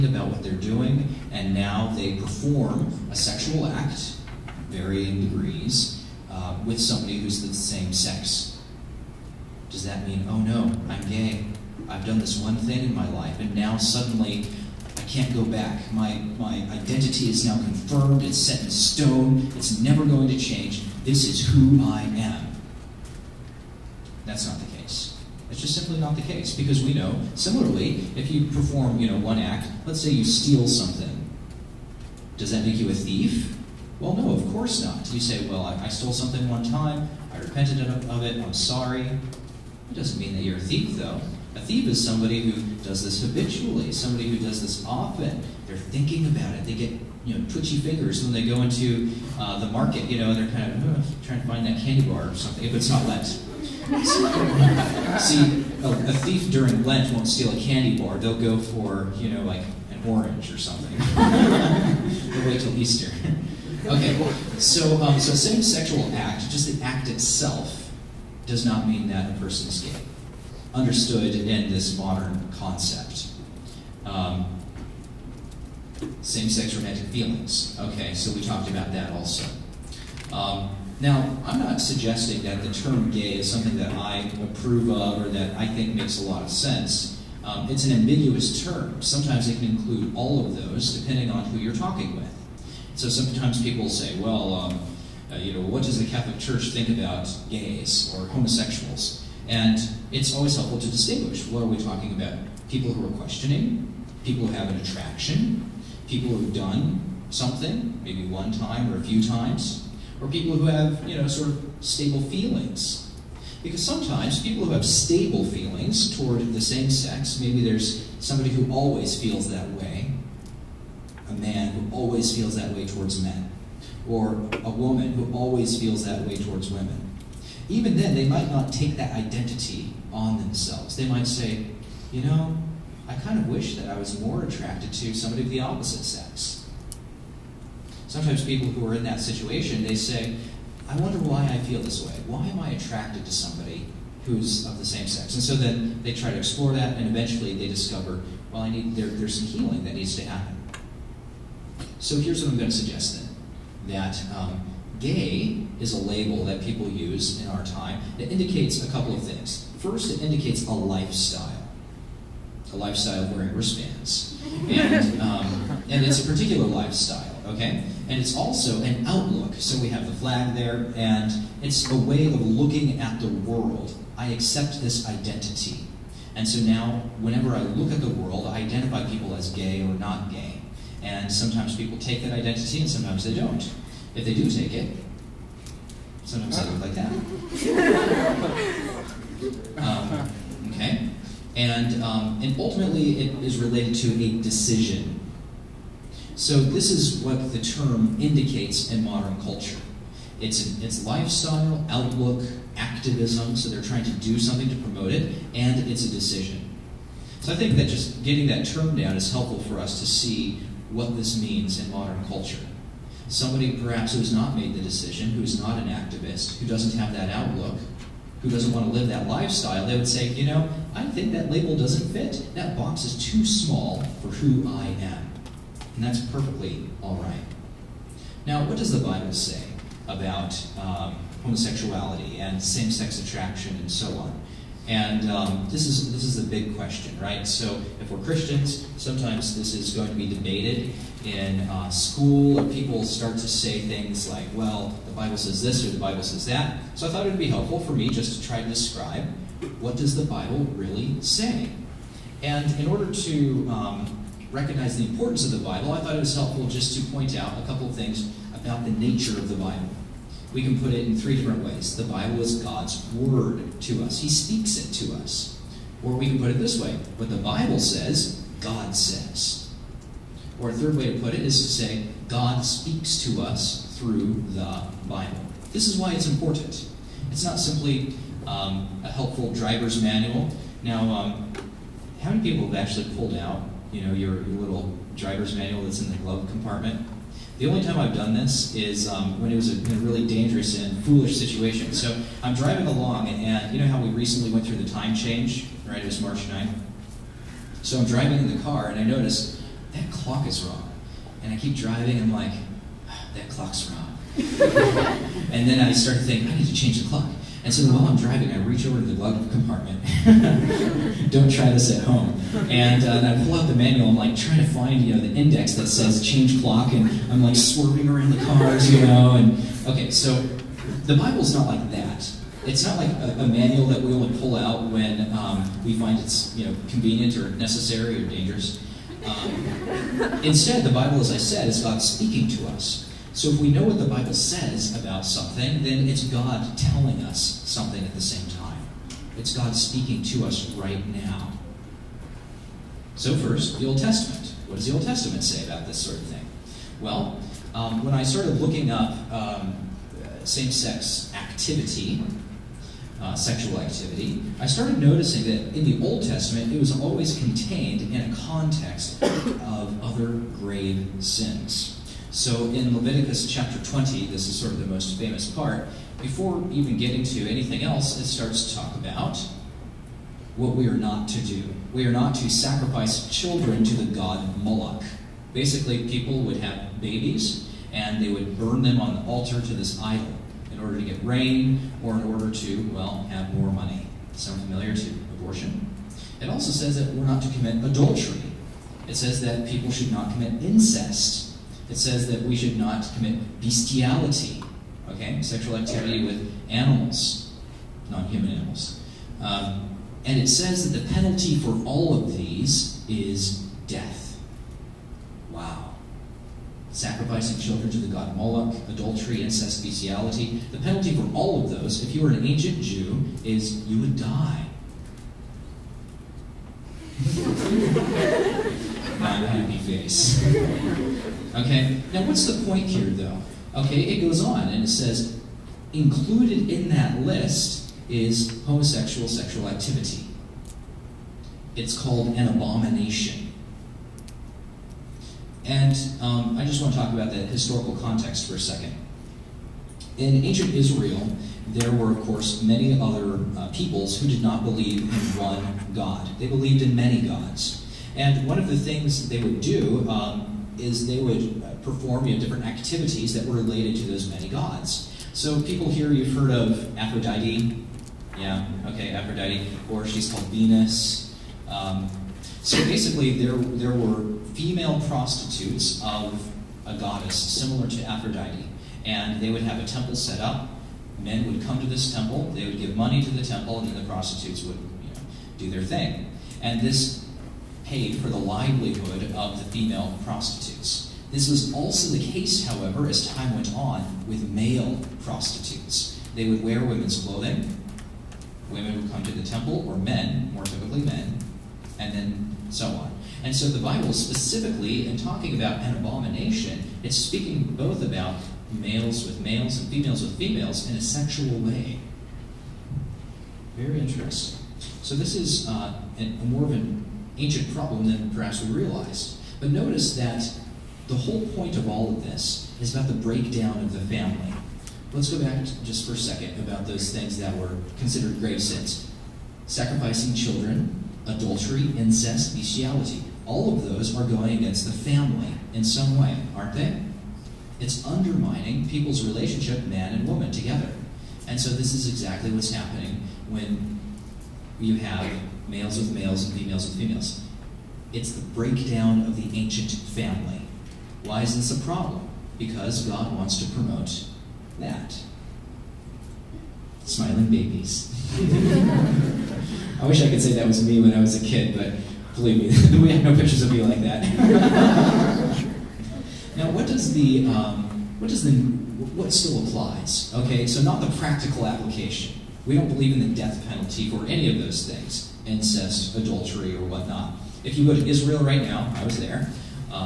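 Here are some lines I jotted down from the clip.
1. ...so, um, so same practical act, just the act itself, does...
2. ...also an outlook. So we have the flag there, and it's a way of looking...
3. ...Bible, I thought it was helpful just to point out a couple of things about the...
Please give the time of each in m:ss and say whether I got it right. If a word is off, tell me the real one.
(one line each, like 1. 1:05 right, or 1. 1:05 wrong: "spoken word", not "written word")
1. 1:04 wrong: "sexual", not "practical"
2. 2:48 right
3. 4:15 right.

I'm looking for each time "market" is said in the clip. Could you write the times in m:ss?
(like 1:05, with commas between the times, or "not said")
0:49.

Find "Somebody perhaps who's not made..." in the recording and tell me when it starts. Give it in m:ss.
3:33.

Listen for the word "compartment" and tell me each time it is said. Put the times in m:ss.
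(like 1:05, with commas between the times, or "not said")
4:46, 5:09.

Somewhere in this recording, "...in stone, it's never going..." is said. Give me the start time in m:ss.
0:18.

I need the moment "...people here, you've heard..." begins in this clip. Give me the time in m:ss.
7:35.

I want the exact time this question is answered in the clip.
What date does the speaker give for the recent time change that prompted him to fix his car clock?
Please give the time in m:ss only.
4:56.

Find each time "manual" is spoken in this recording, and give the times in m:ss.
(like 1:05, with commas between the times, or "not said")
4:40, 4:45, 5:13, 5:23.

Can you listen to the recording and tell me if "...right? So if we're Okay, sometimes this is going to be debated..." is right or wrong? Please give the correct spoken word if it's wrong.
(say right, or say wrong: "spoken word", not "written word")
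wrong: "Christians", not "Okay".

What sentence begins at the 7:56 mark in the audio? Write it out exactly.
And this paid for the livelihood of the female prostitutes.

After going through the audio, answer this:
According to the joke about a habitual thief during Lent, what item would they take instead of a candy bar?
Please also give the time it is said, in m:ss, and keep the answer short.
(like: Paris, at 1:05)
An orange, at 0:59.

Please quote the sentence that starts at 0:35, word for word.
You say, well, I, I stole something one time, I repented of, of it, I'm sorry.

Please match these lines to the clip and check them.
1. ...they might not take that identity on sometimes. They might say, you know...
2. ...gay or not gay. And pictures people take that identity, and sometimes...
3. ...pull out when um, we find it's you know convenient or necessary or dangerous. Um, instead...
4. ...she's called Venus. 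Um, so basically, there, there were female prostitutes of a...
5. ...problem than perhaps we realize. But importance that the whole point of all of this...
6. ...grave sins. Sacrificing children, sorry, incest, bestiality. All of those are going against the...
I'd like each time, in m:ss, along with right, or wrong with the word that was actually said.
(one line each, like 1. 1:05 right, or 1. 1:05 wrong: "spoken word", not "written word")
1. 2:08 wrong: "themselves", not "sometimes"
2. 2:59 wrong: "sometimes", not "pictures"
3. 5:24 right
4. 7:40 right
5. 8:27 wrong: "notice", not "importance"
6. 8:38 wrong: "adultery", not "sorry".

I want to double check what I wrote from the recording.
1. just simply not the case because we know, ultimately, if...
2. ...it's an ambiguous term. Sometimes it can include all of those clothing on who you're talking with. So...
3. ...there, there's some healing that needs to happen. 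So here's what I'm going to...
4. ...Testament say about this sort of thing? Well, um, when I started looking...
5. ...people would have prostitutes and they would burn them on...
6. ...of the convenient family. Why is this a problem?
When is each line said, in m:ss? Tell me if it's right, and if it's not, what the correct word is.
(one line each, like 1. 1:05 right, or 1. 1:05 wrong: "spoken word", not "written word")
1. 0:25 wrong: "similarly", not "ultimately"
2. 1:27 wrong: "depending", not "clothing"
3. 2:28 right
4. 5:45 right
5. 6:16 wrong: "babies", not "prostitutes"
6. 8:59 wrong: "ancient", not "convenient".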